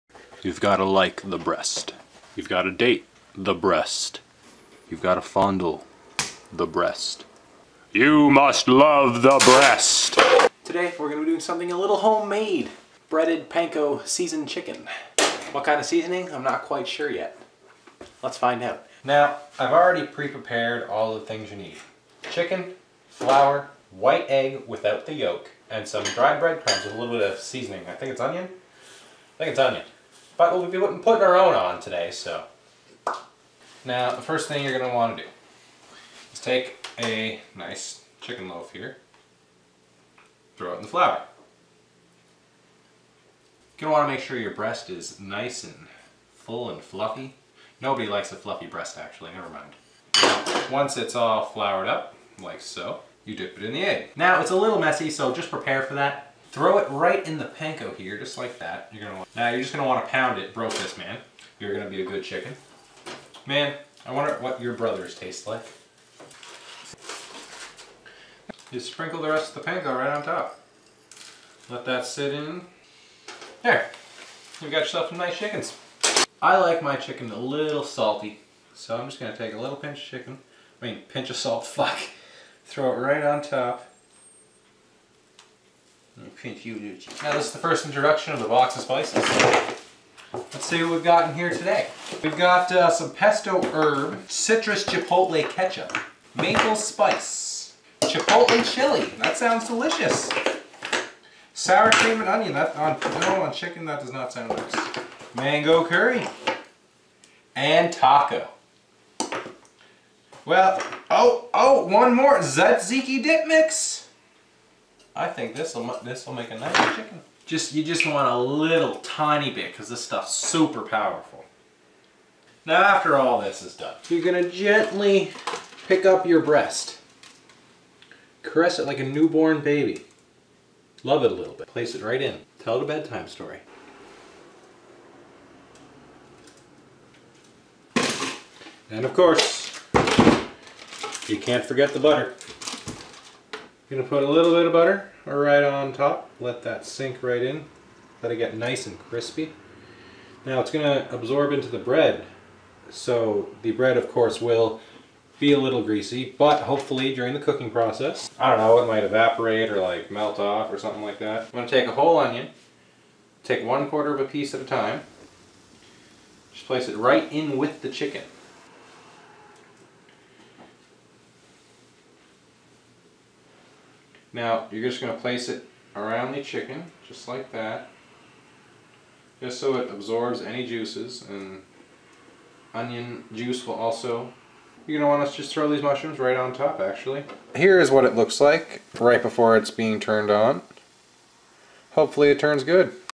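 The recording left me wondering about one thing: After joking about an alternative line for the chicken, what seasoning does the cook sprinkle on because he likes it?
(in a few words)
salt.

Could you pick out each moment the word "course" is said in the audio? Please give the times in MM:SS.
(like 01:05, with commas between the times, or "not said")
02:19, 02:34.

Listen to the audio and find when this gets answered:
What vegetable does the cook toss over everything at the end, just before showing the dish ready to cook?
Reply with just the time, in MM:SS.
03:05.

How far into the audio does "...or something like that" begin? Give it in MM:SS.
02:40.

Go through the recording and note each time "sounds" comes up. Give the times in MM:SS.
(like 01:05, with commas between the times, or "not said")
01:39, 01:44.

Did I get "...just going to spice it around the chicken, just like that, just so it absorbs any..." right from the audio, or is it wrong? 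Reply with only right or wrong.
wrong.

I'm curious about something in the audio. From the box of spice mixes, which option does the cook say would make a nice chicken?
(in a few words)
tzatziki dip mix.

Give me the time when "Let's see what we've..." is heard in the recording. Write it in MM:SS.
01:30.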